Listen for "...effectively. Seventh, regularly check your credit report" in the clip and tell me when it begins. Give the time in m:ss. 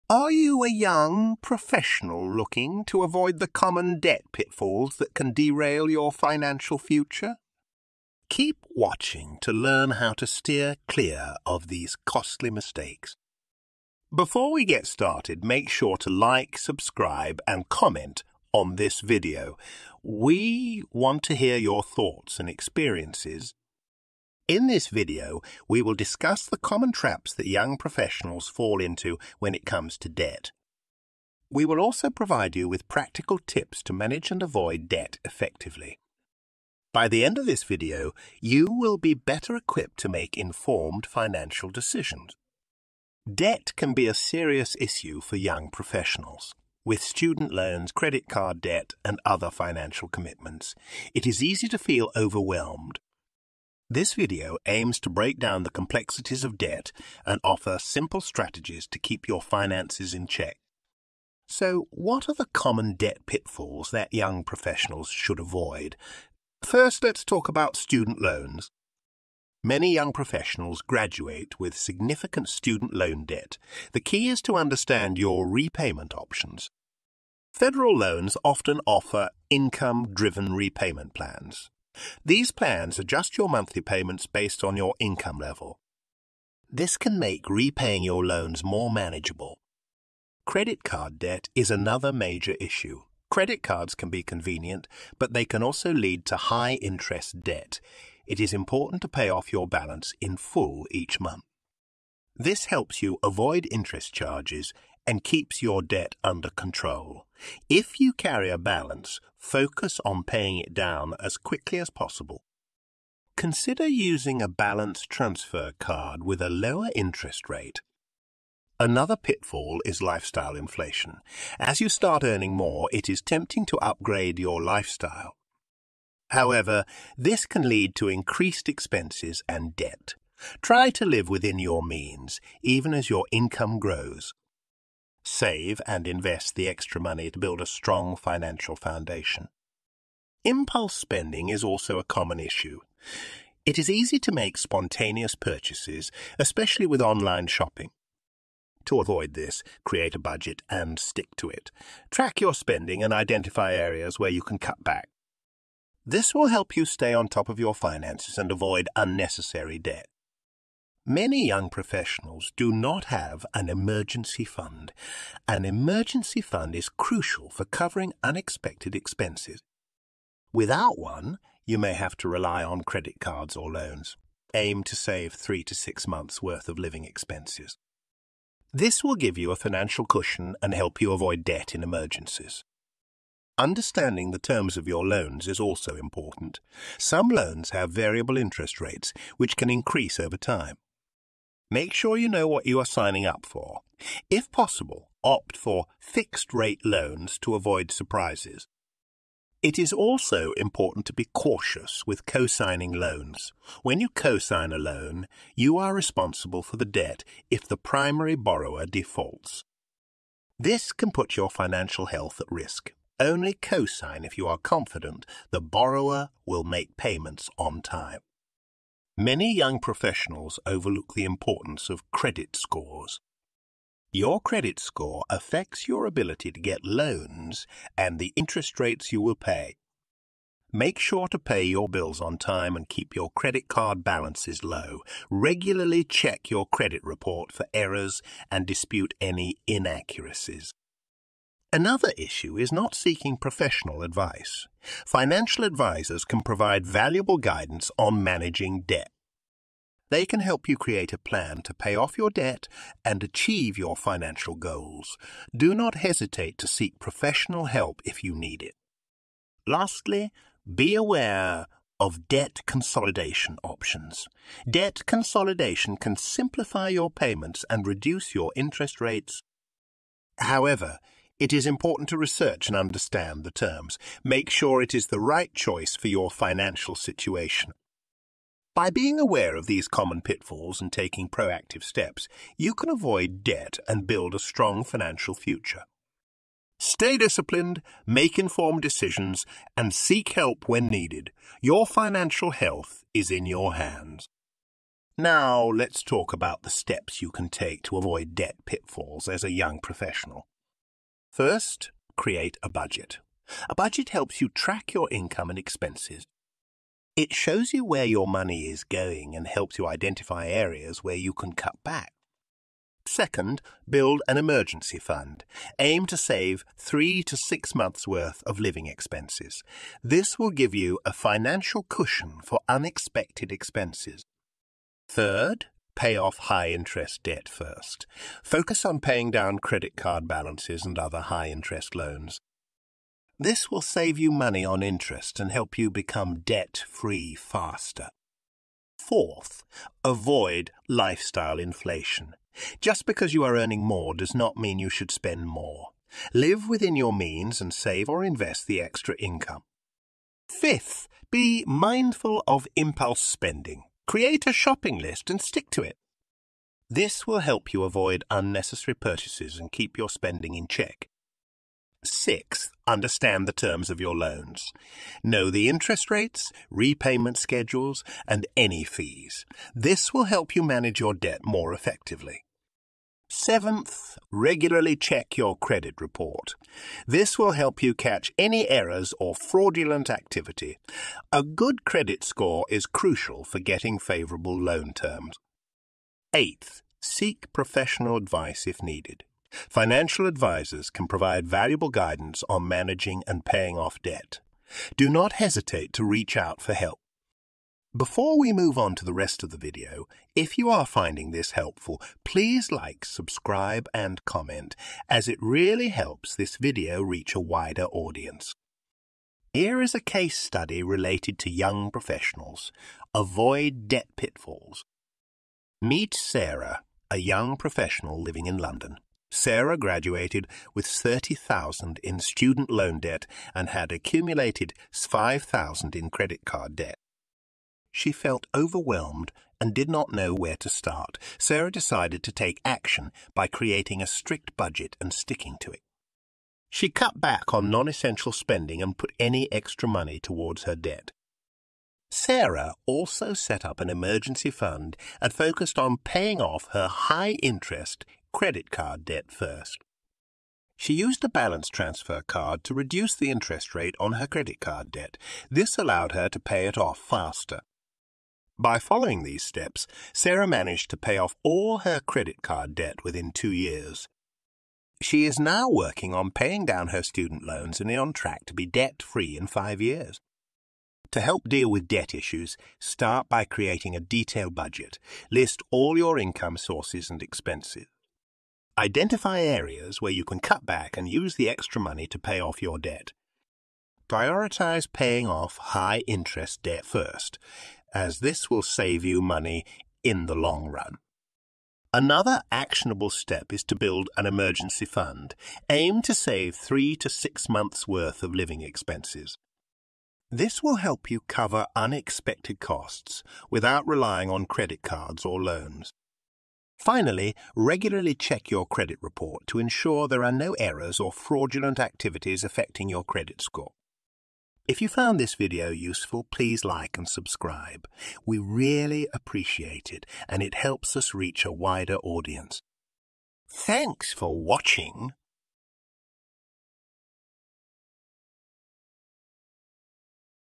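6:11.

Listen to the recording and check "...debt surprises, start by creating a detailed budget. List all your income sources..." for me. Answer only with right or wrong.
wrong.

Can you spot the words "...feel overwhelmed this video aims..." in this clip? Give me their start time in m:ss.
0:51.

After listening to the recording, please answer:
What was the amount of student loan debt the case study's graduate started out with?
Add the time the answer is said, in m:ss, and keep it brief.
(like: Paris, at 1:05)
30,000, at 7:00.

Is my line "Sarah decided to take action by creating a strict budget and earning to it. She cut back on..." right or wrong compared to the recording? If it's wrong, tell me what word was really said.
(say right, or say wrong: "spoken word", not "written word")
wrong: "sticking", not "earning".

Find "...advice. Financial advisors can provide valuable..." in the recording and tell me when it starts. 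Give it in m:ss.
4:04.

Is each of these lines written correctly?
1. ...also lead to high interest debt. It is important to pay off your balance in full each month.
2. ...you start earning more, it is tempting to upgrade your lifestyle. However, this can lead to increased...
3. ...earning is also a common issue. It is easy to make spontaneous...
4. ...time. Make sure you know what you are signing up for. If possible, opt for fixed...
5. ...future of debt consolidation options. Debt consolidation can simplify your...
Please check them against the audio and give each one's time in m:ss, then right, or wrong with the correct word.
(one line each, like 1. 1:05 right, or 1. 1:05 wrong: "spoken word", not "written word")
1. 1:35 right
2. 2:01 right
3. 2:20 wrong: "spending", not "earning"
4. 3:10 right
5. 4:20 wrong: "aware", not "future".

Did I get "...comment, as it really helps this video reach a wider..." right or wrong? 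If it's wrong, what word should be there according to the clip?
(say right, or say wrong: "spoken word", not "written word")
right.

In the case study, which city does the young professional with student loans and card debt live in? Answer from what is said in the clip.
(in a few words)
London.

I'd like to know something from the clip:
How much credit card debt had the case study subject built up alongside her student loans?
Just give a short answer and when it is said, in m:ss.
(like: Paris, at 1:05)
5,000, at 7:04.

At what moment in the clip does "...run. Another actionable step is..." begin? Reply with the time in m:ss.
8:10.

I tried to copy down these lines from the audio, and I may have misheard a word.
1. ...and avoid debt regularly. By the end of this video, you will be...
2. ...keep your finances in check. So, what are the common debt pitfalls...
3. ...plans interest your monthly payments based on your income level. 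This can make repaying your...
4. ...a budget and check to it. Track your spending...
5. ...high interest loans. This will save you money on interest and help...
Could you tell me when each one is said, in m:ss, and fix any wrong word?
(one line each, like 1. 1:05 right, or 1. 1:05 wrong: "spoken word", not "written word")
1. 0:34 wrong: "effectively", not "regularly"
2. 0:58 right
3. 1:22 wrong: "adjust", not "interest"
4. 2:30 wrong: "stick", not "check"
5. 5:31 right.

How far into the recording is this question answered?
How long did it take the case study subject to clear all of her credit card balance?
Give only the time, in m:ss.
7:43.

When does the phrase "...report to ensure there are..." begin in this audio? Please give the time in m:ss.
8:29.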